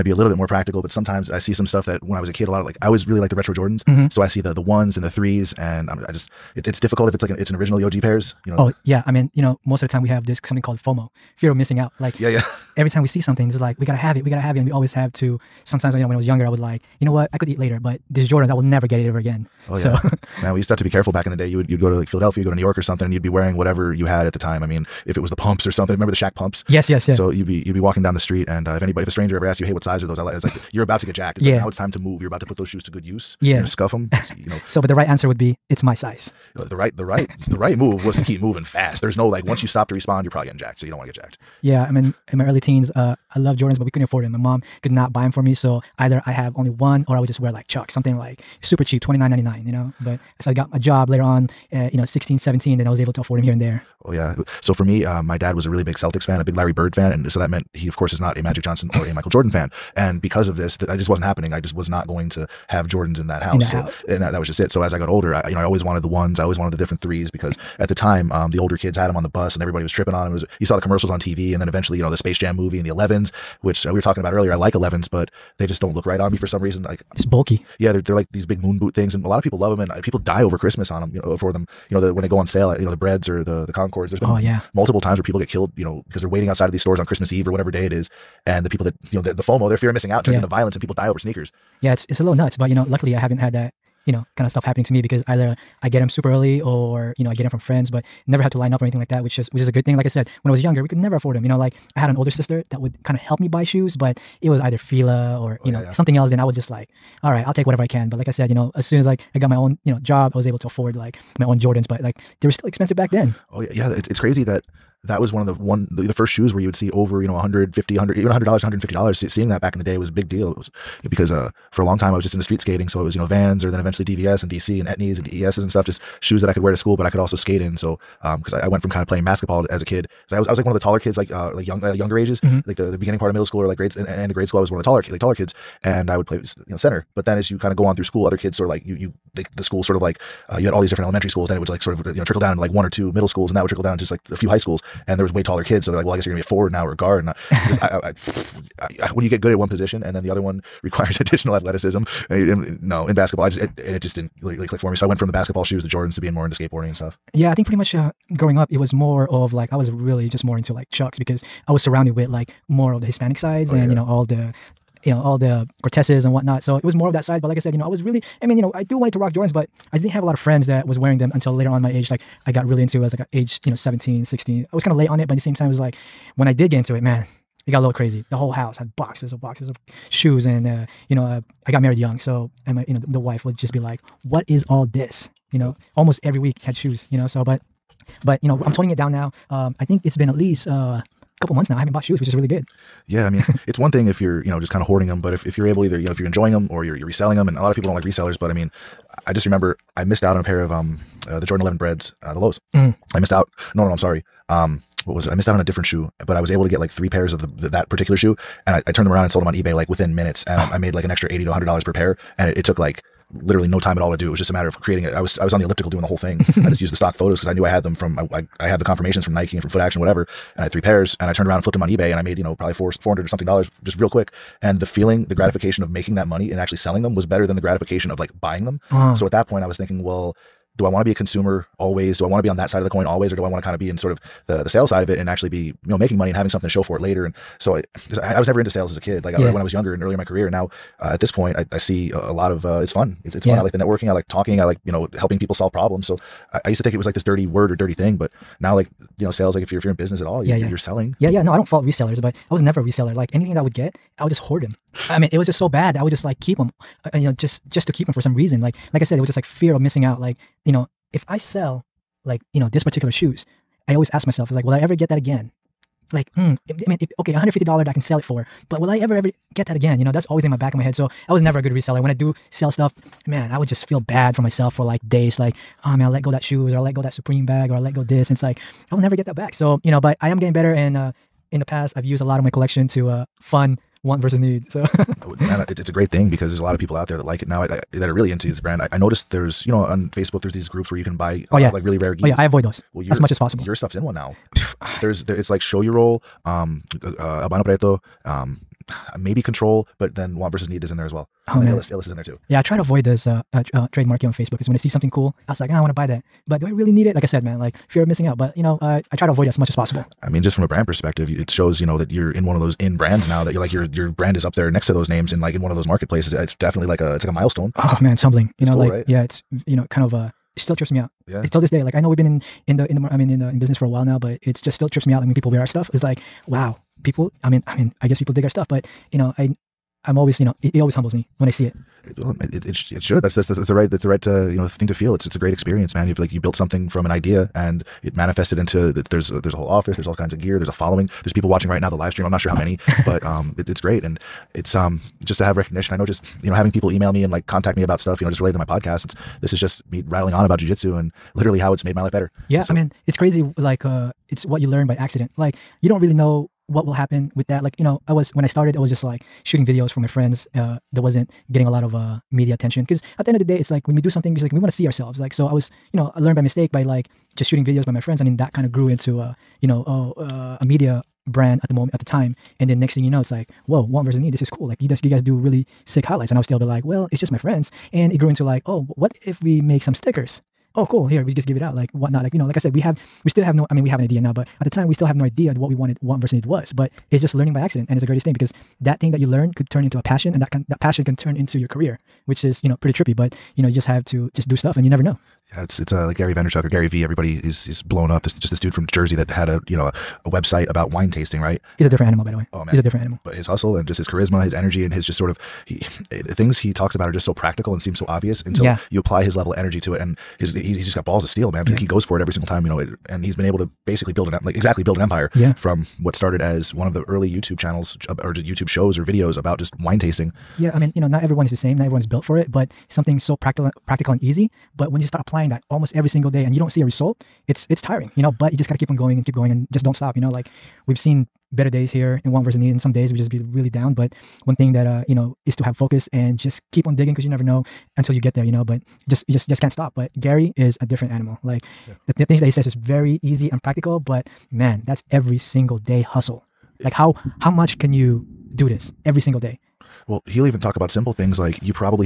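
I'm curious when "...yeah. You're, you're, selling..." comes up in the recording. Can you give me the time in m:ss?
4:10.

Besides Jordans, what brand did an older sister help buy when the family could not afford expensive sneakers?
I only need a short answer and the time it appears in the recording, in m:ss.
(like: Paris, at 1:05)
Fila, at 1:44.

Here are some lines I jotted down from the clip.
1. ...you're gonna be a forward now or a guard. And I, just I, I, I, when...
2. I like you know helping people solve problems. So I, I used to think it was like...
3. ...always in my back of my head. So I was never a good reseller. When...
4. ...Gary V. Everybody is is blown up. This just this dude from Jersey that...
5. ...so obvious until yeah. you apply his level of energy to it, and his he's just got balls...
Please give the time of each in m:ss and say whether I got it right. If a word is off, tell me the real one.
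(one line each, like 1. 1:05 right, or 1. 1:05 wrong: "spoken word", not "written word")
1. 2:26 right
2. 4:04 right
3. 4:30 right
4. 6:36 right
5. 6:47 right.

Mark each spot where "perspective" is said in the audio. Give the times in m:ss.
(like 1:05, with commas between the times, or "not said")
5:10.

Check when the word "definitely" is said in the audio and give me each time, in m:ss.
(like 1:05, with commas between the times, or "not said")
5:16.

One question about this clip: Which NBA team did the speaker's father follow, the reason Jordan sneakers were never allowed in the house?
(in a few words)
Celtics.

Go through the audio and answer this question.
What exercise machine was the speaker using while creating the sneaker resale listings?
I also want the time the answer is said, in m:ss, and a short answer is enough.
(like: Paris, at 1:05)
elliptical, at 3:35.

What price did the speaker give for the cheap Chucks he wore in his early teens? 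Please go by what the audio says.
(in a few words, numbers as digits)
$29.99.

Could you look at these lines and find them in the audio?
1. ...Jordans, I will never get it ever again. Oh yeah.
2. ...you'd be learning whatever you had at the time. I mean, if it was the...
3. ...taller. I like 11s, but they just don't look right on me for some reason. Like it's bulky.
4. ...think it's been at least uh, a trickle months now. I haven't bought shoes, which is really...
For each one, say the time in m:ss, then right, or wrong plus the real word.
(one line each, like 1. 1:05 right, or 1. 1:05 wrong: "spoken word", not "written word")
1. 0:18 right
2. 0:23 wrong: "wearing", not "learning"
3. 1:14 wrong: "earlier", not "taller"
4. 3:09 wrong: "couple", not "trickle".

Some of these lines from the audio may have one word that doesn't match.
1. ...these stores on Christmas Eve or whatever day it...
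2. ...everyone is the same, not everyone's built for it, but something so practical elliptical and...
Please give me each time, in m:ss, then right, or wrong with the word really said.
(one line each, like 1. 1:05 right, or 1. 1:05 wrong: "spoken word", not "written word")
1. 1:26 right
2. 7:01 wrong: "practical", not "elliptical".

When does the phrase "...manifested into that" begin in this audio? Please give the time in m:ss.
5:38.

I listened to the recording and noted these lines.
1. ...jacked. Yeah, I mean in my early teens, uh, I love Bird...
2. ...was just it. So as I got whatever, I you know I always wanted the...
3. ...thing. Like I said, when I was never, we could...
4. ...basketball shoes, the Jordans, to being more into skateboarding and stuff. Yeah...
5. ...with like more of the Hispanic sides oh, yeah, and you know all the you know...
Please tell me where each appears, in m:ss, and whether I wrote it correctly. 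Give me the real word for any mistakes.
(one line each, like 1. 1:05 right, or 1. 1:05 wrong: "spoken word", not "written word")
1. 0:41 wrong: "Jordans", not "Bird"
2. 1:04 wrong: "older", not "whatever"
3. 1:39 wrong: "younger", not "never"
4. 2:35 right
5. 2:42 right.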